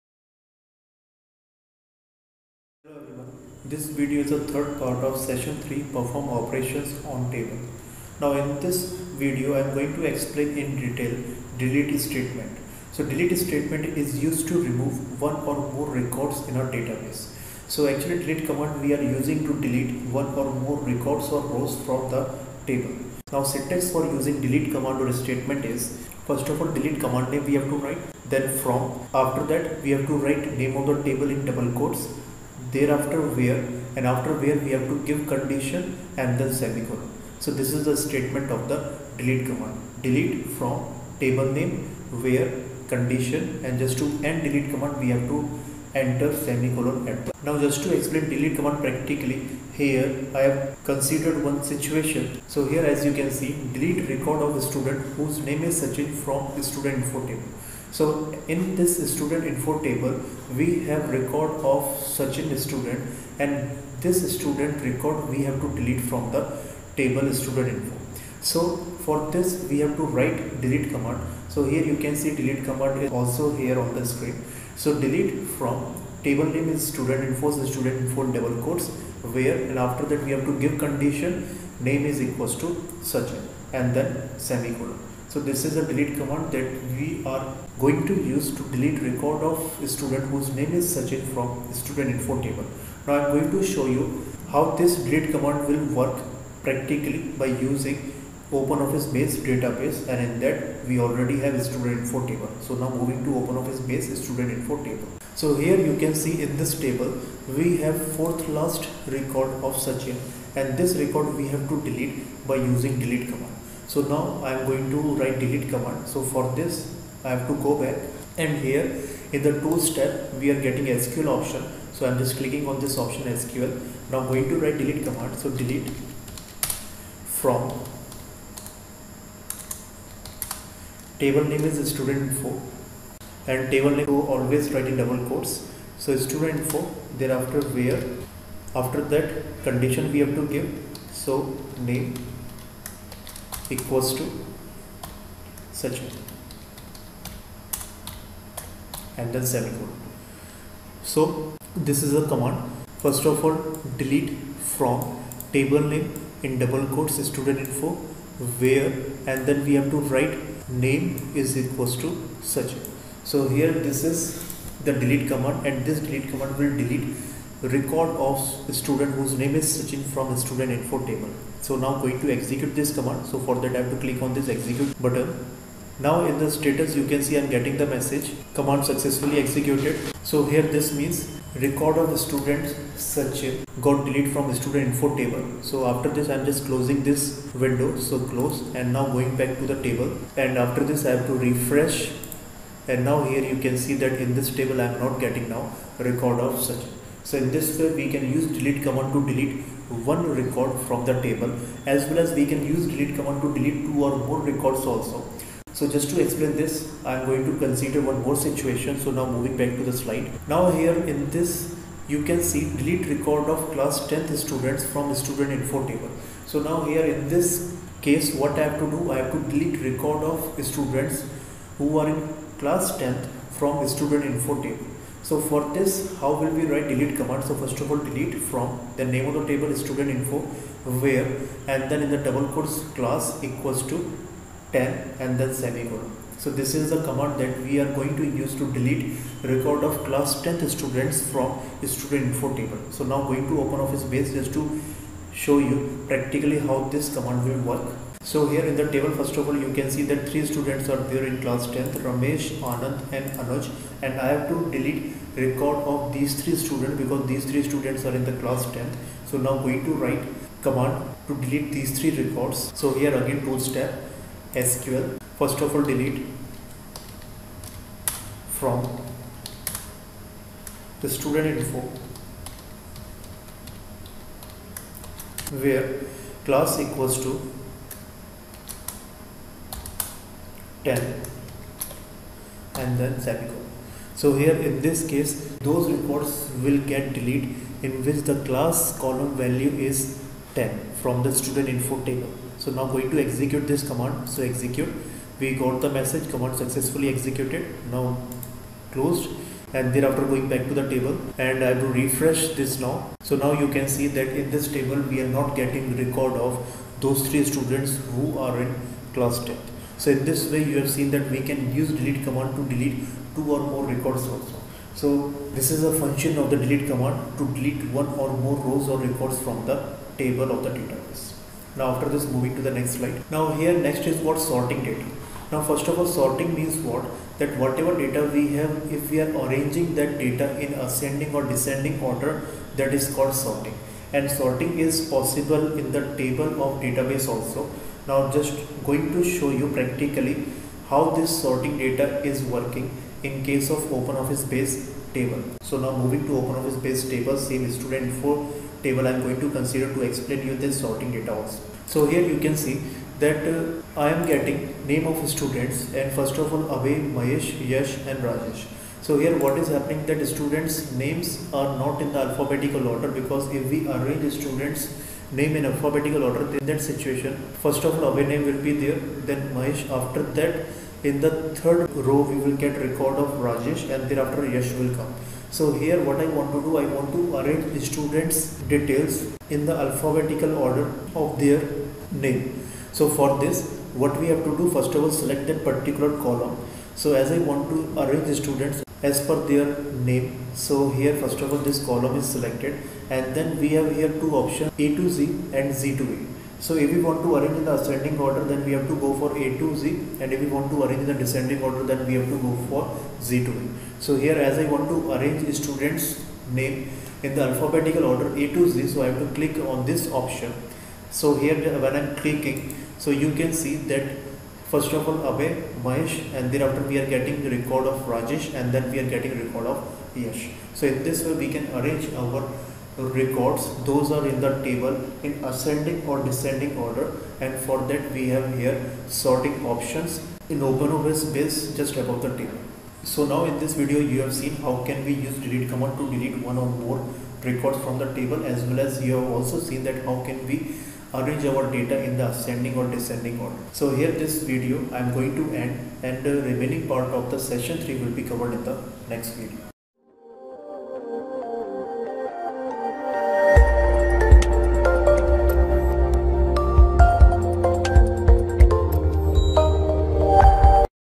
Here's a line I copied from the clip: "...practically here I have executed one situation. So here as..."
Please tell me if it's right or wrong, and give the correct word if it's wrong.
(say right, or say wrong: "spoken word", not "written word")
wrong: "considered", not "executed".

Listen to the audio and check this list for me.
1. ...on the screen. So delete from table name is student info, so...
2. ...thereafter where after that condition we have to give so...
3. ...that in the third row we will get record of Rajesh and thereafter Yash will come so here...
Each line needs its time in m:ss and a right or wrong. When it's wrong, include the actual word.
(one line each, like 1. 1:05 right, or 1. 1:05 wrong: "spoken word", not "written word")
1. 1:13 right
2. 2:17 right
3. 6:10 right.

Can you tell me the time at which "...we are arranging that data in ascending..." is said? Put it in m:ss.
5:29.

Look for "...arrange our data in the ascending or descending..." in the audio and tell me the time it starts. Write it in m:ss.
7:21.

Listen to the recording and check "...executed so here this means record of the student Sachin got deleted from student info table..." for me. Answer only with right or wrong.
right.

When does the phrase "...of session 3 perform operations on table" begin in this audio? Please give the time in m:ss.
0:05.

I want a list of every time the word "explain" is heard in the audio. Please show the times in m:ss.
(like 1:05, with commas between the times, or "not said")
0:10, 0:47, 3:26, 5:50.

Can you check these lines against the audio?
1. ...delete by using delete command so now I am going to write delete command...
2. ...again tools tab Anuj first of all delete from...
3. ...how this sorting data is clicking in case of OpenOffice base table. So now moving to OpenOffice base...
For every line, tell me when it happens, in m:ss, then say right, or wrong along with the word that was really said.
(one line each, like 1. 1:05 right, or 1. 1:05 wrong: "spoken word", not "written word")
1. 1:51 right
2. 4:23 wrong: "SQL", not "Anuj"
3. 5:40 wrong: "working", not "clicking".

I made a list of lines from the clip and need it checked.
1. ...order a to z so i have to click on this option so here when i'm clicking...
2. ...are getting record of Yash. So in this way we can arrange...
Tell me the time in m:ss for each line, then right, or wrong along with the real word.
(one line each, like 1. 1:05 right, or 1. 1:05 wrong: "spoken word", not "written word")
1. 6:48 right
2. 6:58 right.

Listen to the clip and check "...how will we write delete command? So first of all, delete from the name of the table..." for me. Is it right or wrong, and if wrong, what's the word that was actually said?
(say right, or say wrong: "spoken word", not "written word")
right.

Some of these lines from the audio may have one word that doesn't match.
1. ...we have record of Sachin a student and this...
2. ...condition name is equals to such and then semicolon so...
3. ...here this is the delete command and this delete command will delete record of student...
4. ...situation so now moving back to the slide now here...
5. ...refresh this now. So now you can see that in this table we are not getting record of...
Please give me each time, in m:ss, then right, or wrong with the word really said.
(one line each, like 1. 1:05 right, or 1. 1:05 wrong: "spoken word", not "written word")
1. 1:00 right
2. 1:20 right
3. 2:43 right
4. 3:28 right
5. 5:02 right.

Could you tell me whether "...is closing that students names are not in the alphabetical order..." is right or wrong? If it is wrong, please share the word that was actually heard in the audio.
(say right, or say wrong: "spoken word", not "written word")
wrong: "happening", not "closing".